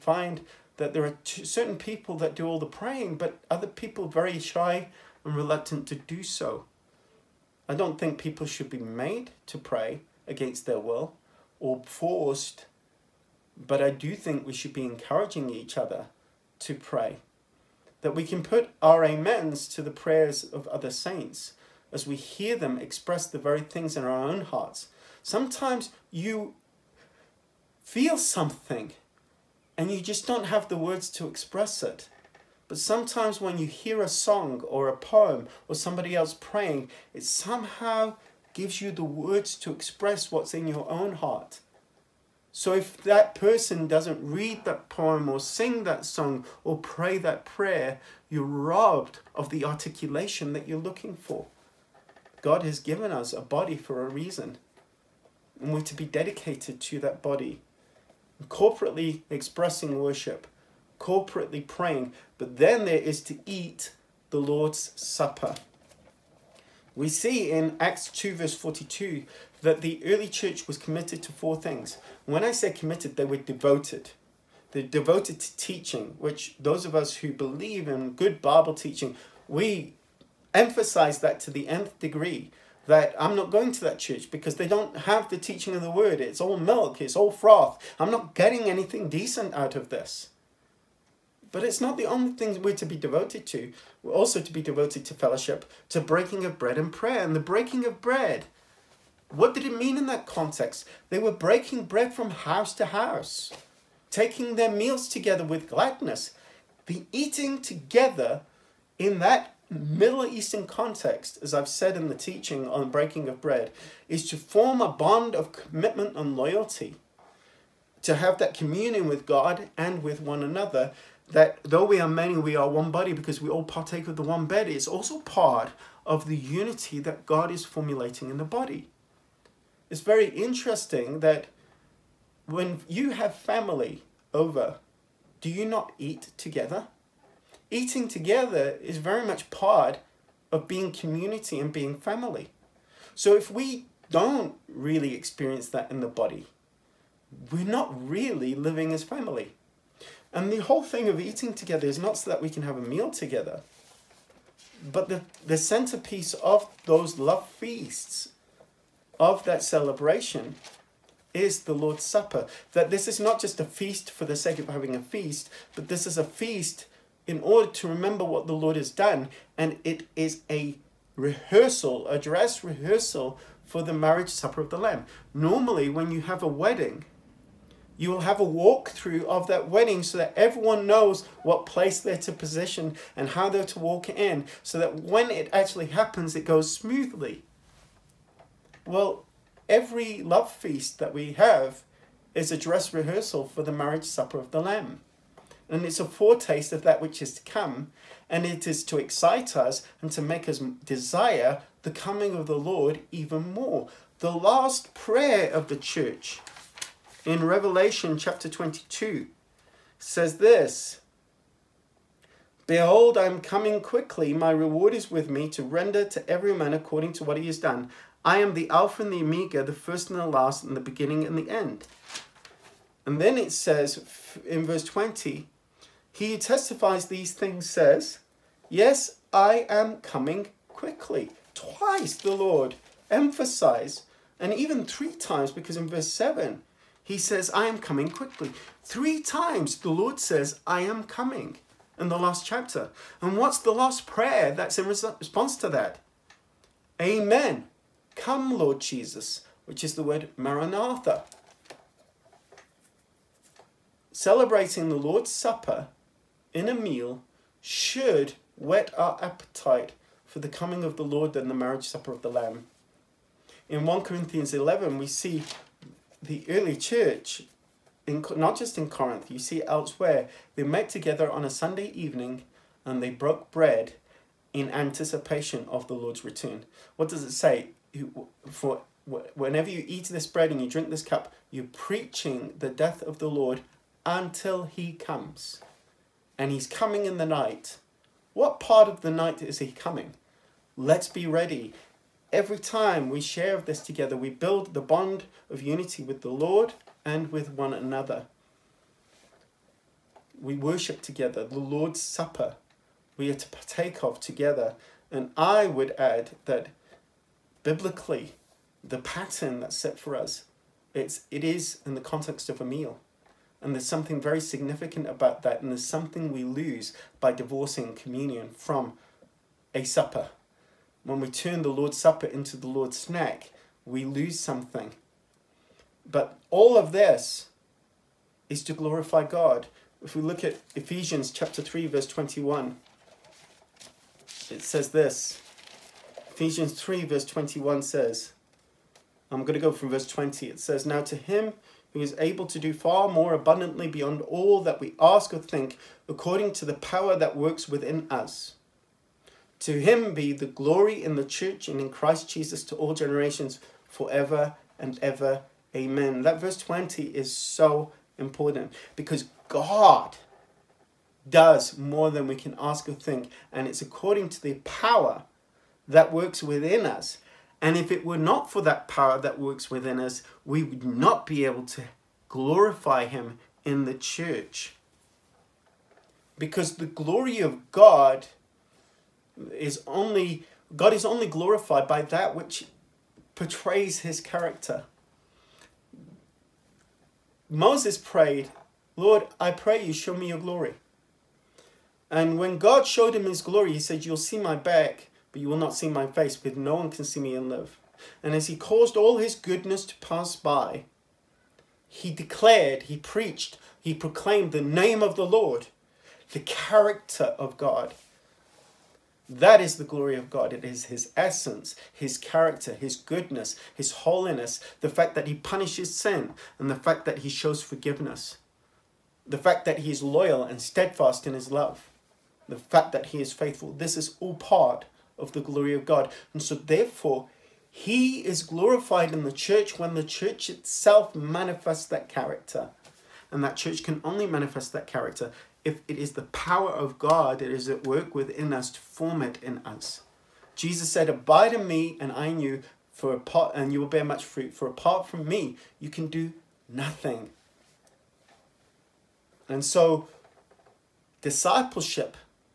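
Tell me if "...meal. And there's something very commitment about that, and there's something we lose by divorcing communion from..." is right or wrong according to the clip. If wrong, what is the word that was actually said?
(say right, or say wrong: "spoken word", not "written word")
wrong: "significant", not "commitment".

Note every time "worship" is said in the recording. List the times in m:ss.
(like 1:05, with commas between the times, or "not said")
0:59, 5:00.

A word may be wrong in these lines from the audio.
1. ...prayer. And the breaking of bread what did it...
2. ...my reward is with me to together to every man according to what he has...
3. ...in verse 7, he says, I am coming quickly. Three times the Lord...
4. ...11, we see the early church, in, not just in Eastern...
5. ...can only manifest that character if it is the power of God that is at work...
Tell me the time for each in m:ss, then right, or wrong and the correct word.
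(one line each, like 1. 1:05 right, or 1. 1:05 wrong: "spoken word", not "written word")
1. 1:36 right
2. 3:34 wrong: "render", not "together"
3. 3:55 right
4. 4:24 wrong: "Corinth", not "Eastern"
5. 7:13 right.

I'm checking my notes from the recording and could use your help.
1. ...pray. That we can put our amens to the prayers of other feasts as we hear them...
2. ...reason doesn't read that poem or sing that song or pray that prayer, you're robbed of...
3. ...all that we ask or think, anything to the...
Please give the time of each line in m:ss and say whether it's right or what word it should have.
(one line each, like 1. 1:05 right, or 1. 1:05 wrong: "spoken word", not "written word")
1. 0:16 wrong: "saints", not "feasts"
2. 0:43 wrong: "person", not "reason"
3. 5:44 wrong: "according", not "anything".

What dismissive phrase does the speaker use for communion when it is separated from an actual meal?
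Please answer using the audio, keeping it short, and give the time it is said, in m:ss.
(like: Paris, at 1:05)
the Lord's snack, at 5:22.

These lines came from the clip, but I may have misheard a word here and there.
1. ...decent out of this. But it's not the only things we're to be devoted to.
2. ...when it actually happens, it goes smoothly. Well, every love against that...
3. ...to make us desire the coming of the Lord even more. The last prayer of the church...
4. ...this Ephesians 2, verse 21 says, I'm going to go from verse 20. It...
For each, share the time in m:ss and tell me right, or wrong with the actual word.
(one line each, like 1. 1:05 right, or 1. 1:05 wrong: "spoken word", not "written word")
1. 1:29 right
2. 3:05 wrong: "feast", not "against"
3. 3:20 right
4. 5:34 wrong: "3", not "2".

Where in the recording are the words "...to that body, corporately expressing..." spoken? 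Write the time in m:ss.
0:56.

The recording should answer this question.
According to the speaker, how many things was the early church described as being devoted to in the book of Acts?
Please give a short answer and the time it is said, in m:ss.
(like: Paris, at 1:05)
4, at 1:11.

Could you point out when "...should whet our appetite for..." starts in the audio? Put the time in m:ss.
4:17.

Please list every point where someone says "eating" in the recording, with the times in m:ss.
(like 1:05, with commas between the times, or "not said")
1:47, 2:17, 2:31.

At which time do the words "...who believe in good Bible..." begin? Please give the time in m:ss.
1:17.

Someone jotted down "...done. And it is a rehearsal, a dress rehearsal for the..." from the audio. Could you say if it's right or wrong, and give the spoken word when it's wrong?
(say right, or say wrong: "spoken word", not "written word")
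right.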